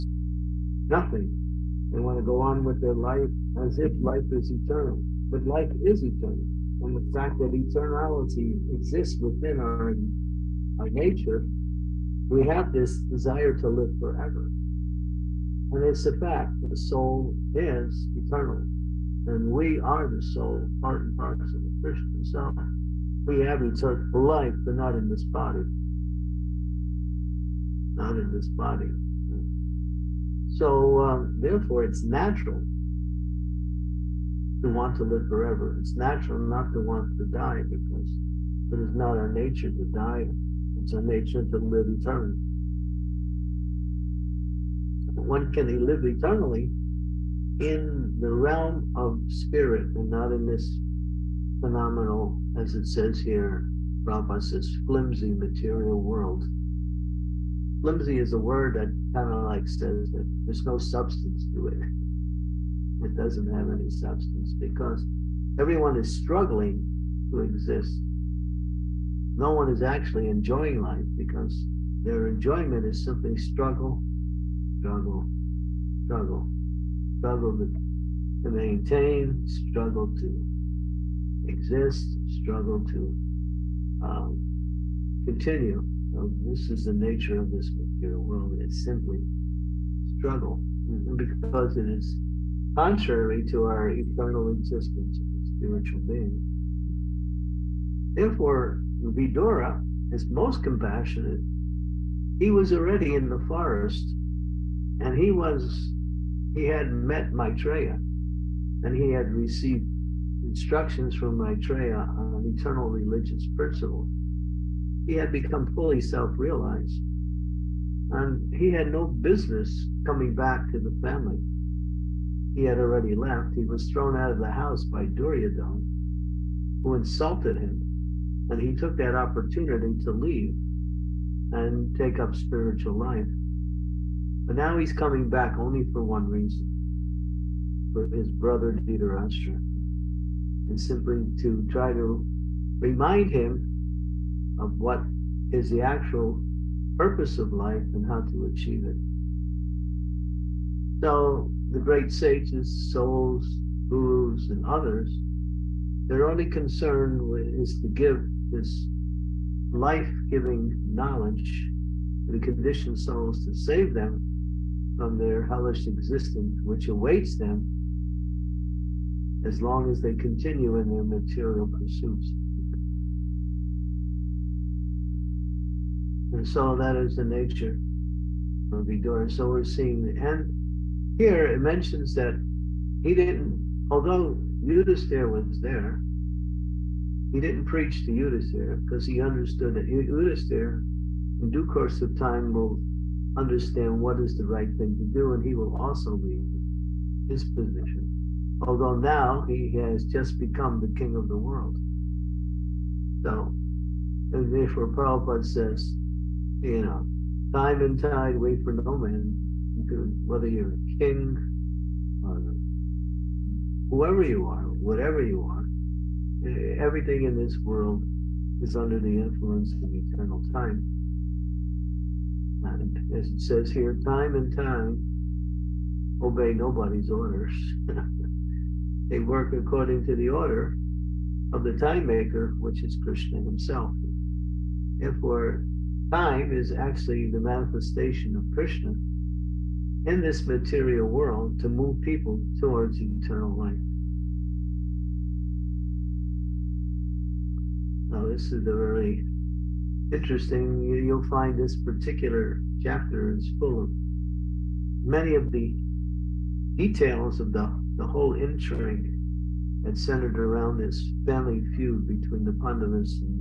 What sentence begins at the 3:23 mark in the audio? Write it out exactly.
So, and therefore, Prabhupada says, you know, time and tide, wait for no man.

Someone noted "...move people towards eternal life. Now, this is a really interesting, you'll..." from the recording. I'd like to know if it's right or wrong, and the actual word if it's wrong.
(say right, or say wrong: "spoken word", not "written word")
right.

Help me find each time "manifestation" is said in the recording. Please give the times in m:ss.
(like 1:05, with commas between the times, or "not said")
3:57.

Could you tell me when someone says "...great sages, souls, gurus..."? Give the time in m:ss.
2:31.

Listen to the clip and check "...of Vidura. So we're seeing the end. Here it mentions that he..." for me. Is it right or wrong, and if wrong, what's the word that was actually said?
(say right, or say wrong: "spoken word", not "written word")
right.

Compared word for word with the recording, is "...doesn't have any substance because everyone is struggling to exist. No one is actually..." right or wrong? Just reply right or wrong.
right.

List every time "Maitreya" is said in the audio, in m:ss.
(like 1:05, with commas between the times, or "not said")
1:47, 1:51.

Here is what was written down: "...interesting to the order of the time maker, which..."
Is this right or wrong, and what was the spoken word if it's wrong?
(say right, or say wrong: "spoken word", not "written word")
wrong: "according", not "interesting".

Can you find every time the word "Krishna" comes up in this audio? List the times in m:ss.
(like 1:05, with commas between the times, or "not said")
0:21, 3:53, 3:58.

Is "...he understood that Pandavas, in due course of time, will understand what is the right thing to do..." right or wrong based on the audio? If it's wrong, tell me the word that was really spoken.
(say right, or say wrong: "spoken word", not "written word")
wrong: "Yudhisthira", not "Pandavas".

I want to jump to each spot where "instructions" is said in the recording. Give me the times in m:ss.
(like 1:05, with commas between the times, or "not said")
1:50.